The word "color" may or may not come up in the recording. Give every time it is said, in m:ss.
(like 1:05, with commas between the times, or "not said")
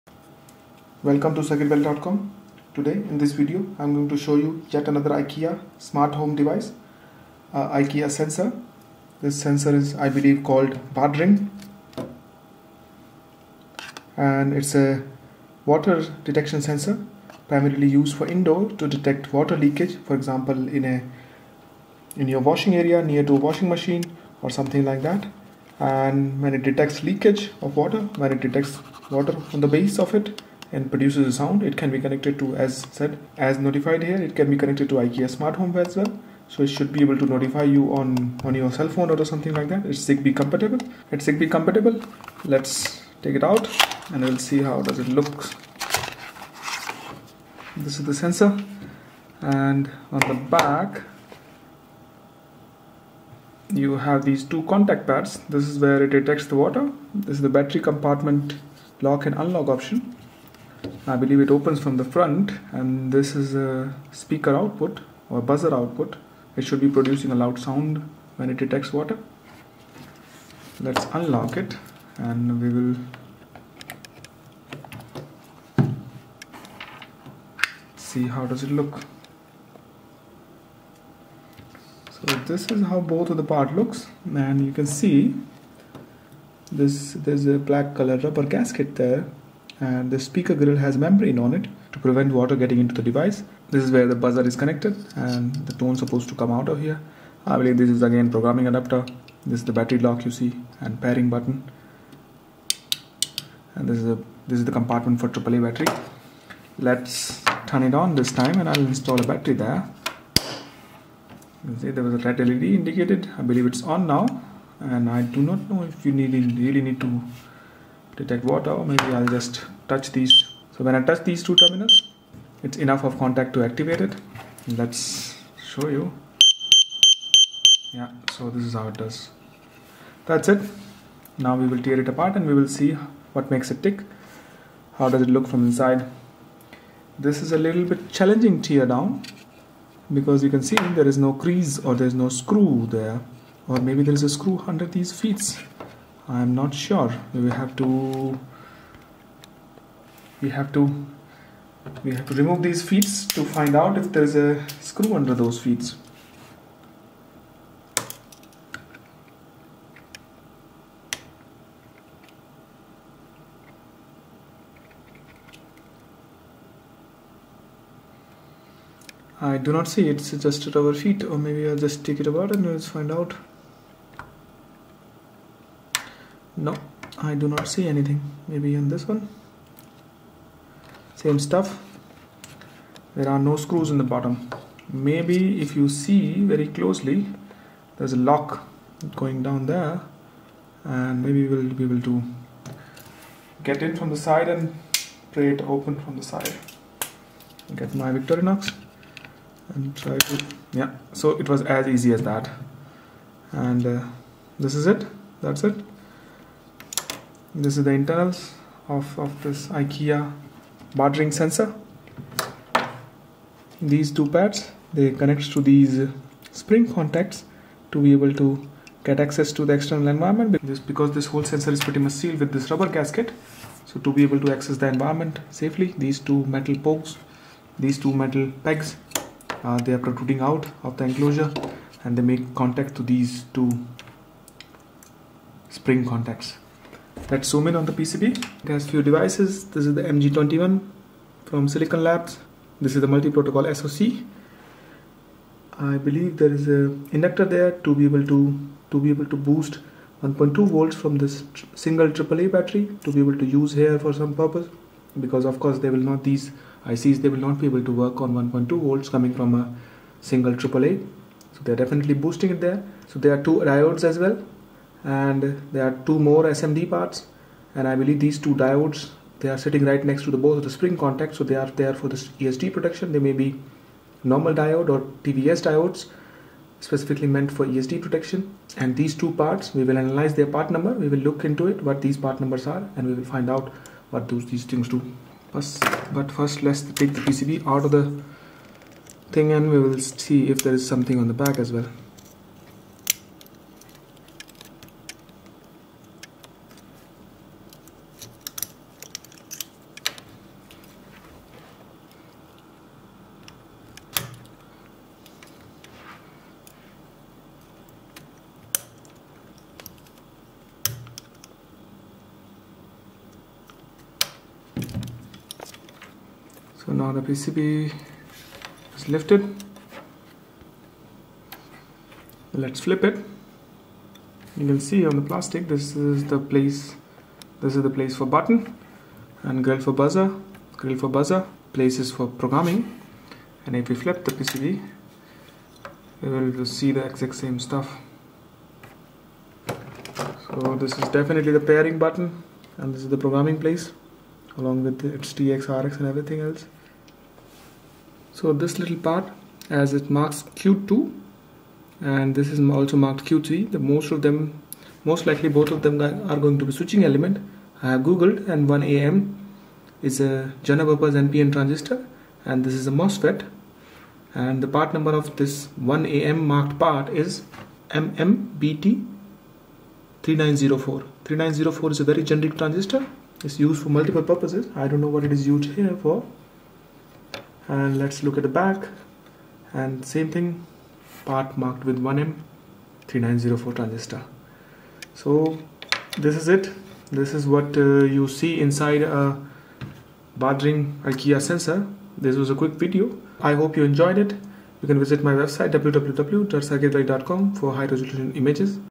1:27.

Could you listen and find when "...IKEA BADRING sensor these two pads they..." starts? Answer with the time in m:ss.
3:29.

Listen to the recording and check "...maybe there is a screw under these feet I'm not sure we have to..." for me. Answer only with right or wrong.
right.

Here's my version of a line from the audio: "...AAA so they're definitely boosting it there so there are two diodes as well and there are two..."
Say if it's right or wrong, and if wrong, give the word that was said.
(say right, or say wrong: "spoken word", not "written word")
right.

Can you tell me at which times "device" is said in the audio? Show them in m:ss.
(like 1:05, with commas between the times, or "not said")
0:06, 1:33, 3:59.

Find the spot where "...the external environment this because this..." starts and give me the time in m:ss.
3:39.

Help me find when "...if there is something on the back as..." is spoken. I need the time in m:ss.
4:50.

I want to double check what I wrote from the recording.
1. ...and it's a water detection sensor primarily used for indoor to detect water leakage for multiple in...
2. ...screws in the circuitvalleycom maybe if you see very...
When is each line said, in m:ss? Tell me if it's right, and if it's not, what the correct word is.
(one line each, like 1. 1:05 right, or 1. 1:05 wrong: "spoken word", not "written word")
1. 0:14 wrong: "example", not "multiple"
2. 3:03 wrong: "bottom", not "circuitvalleycom".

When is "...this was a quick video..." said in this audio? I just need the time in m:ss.
6:32.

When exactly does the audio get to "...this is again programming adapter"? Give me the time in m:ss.
1:37.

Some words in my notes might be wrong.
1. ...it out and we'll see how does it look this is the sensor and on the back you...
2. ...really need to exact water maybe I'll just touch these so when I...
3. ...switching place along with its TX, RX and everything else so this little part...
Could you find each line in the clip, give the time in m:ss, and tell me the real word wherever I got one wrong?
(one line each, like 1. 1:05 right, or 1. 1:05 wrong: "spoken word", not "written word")
1. 0:43 right
2. 1:56 wrong: "detect", not "exact"
3. 5:43 wrong: "programming", not "switching".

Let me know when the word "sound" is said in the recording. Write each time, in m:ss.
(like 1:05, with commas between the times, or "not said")
0:31, 1:07.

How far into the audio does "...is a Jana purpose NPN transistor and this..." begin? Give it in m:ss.
6:00.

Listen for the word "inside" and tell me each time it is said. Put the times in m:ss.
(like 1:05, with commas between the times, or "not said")
2:15, 6:28.